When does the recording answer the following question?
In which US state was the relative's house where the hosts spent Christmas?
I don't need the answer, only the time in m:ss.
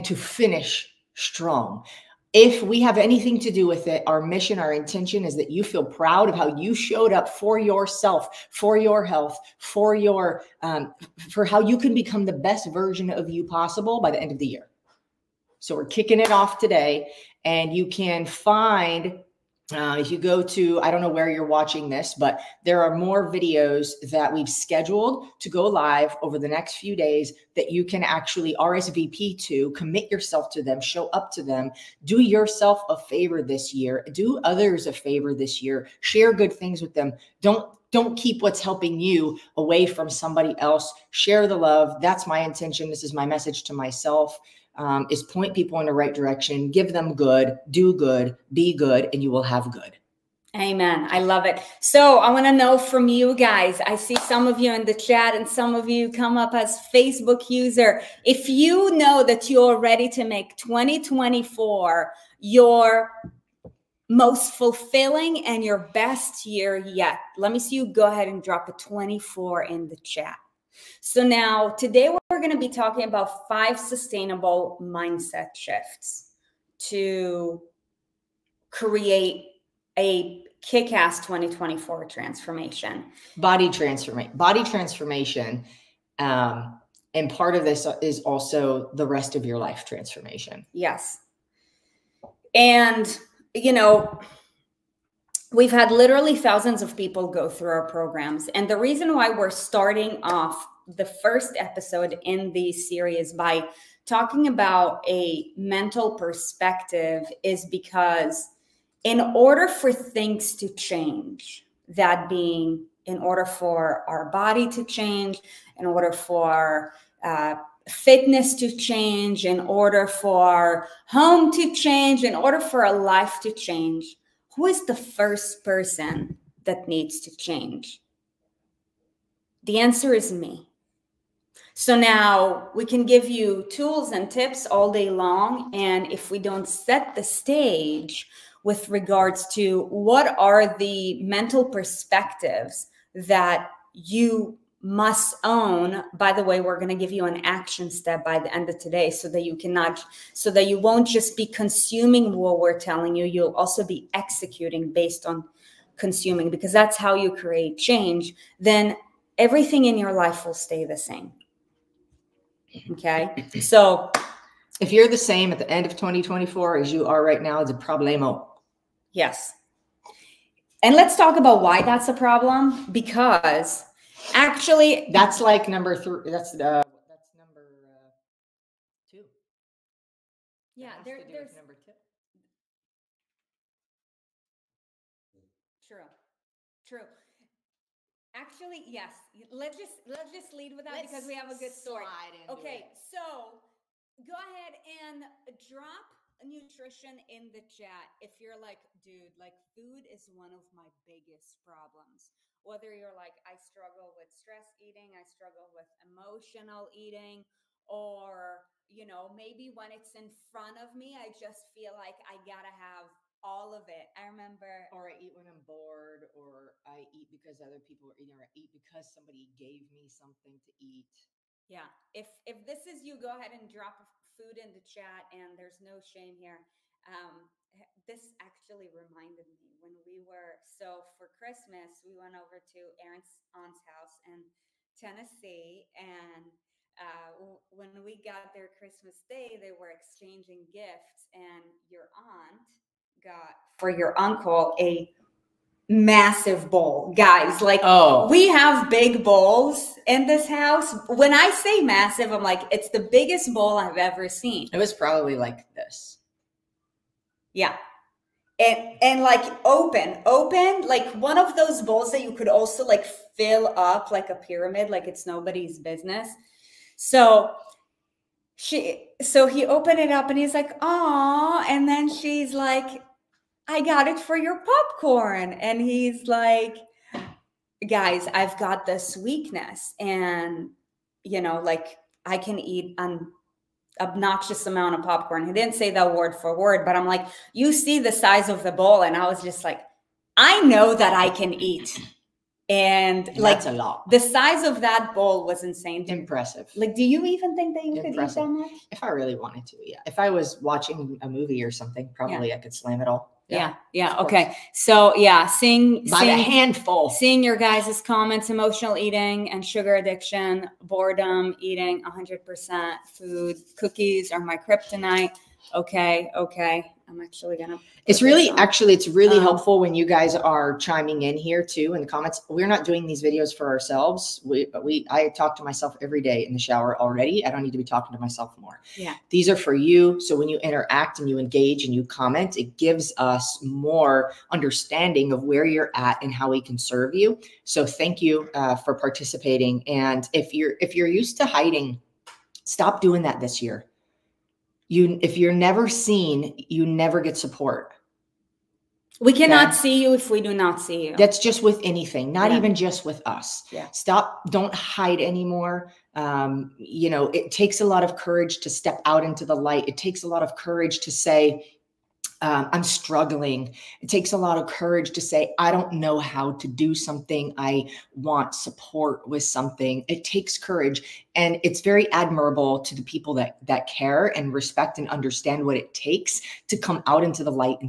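3:54.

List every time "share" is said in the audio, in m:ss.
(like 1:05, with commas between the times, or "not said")
0:36, 0:41.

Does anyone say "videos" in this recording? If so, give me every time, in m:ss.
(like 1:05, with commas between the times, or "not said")
0:23, 5:23.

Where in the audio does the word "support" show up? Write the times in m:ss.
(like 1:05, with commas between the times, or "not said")
5:47, 6:08.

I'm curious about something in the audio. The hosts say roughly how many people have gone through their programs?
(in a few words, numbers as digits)
thousands.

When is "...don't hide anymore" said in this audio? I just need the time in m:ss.
5:54.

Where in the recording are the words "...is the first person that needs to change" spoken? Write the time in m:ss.
2:04.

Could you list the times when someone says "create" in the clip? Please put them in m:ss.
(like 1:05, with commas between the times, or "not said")
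1:18, 2:37.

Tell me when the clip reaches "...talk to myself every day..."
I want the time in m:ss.
5:25.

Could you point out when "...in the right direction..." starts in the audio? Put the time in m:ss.
0:45.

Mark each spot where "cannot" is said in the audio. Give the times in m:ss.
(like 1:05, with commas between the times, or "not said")
2:29, 5:49.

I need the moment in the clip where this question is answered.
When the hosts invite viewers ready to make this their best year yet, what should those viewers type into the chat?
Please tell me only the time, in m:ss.
1:08.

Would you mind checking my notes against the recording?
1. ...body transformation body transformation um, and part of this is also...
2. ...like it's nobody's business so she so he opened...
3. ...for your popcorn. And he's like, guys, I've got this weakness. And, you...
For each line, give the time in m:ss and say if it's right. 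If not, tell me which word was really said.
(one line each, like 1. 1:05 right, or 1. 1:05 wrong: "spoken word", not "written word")
1. 1:23 right
2. 4:24 right
3. 4:34 right.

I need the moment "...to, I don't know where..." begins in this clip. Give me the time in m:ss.
0:20.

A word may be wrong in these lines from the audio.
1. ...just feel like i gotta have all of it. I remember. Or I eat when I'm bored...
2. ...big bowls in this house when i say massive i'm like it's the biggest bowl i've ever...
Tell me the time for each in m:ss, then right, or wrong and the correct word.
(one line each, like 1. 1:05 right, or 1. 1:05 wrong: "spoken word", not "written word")
1. 3:31 right
2. 4:08 right.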